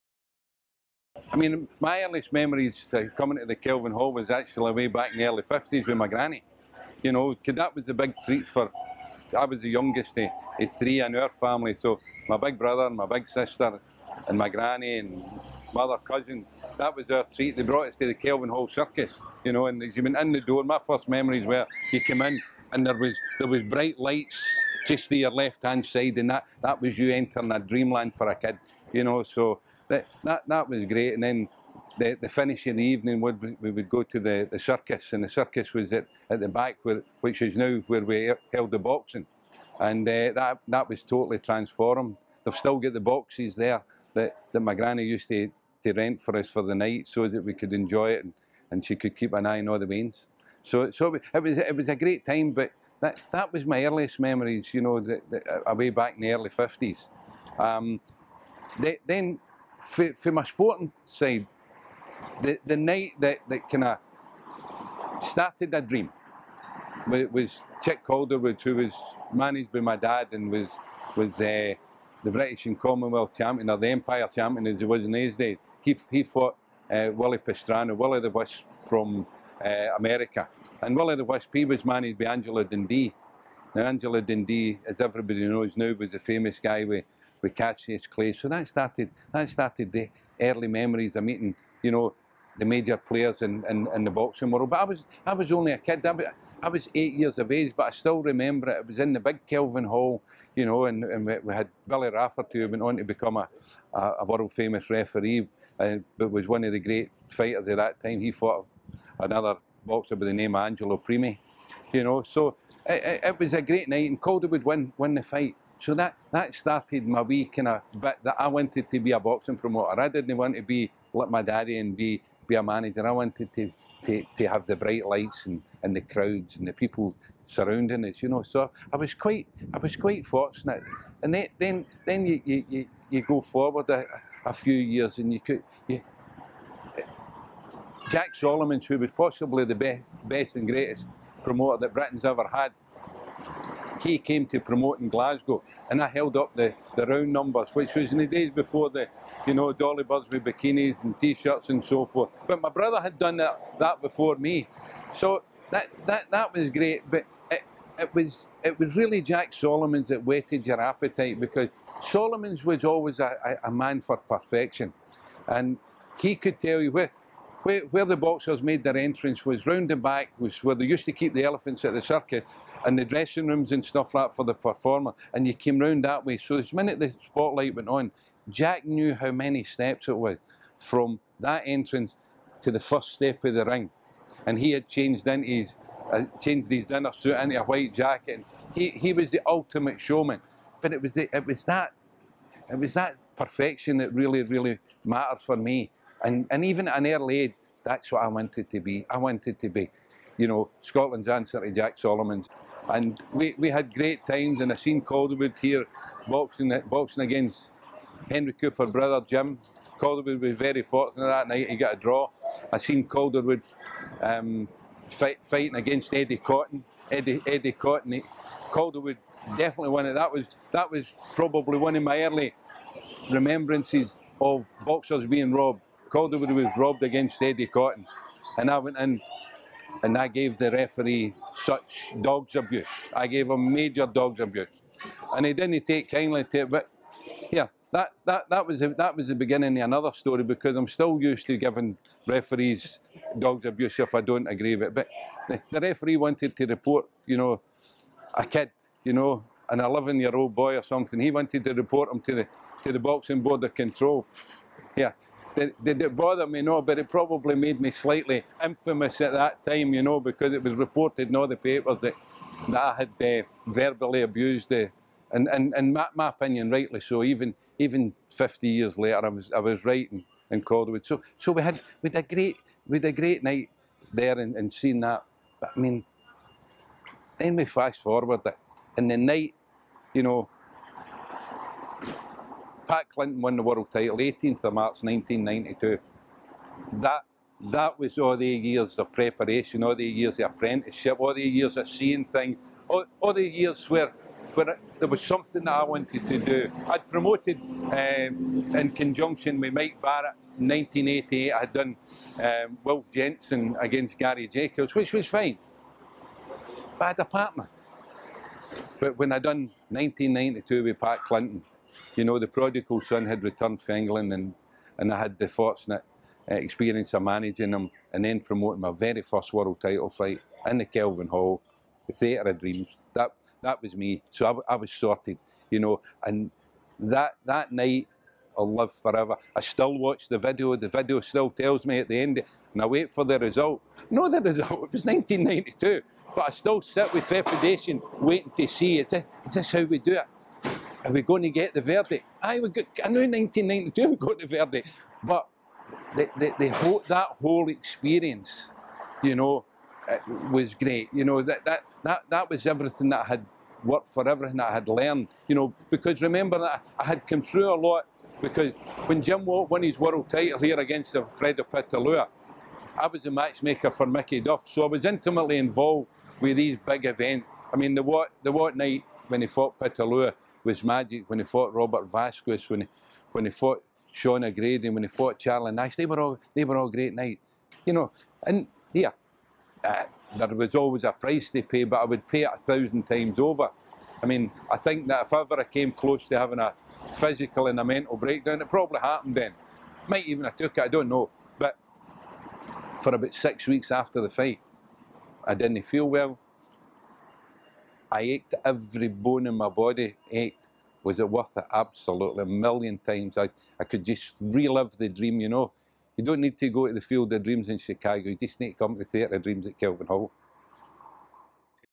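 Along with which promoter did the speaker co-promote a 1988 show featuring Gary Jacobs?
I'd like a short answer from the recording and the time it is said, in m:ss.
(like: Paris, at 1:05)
Mike Barrett, at 4:59.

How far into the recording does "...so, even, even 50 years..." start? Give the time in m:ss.
4:26.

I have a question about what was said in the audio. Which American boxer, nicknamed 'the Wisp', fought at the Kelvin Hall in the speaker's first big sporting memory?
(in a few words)
Willie Pastrano.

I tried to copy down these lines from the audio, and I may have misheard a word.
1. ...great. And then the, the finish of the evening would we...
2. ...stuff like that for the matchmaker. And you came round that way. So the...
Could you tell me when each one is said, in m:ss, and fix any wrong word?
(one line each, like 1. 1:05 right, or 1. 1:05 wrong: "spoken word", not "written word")
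1. 0:30 right
2. 2:53 wrong: "performer", not "matchmaker".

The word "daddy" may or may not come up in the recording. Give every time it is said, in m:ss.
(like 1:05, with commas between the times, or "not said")
2:01.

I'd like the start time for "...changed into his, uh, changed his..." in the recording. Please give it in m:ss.
3:04.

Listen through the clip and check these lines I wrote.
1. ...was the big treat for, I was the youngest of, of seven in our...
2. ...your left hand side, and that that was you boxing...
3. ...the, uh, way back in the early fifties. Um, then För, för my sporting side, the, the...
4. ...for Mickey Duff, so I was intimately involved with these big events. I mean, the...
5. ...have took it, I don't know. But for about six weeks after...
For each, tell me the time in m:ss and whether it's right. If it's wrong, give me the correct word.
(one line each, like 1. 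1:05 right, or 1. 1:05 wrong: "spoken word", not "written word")
1. 0:07 wrong: "three", not "seven"
2. 0:25 wrong: "entering", not "boxing"
3. 0:55 right
4. 6:03 right
5. 6:30 right.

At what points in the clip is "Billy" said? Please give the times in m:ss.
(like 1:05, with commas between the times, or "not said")
1:41.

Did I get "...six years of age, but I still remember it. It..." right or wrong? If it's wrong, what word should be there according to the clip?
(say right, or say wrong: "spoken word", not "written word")
wrong: "eight", not "six".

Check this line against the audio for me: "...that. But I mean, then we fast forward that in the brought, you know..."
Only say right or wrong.
wrong.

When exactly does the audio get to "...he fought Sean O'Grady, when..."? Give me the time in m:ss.
6:13.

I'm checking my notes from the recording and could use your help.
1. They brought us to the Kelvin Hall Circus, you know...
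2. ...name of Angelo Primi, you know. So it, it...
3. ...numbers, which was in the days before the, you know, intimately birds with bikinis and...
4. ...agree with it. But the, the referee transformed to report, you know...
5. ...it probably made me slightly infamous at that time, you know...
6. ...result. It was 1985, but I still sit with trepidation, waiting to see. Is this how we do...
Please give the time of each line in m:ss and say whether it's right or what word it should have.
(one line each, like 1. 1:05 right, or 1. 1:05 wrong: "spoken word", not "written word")
1. 0:17 right
2. 1:50 right
3. 2:27 wrong: "dolly", not "intimately"
4. 4:04 wrong: "wanted", not "transformed"
5. 4:16 right
6. 5:34 wrong: "1992", not "1985".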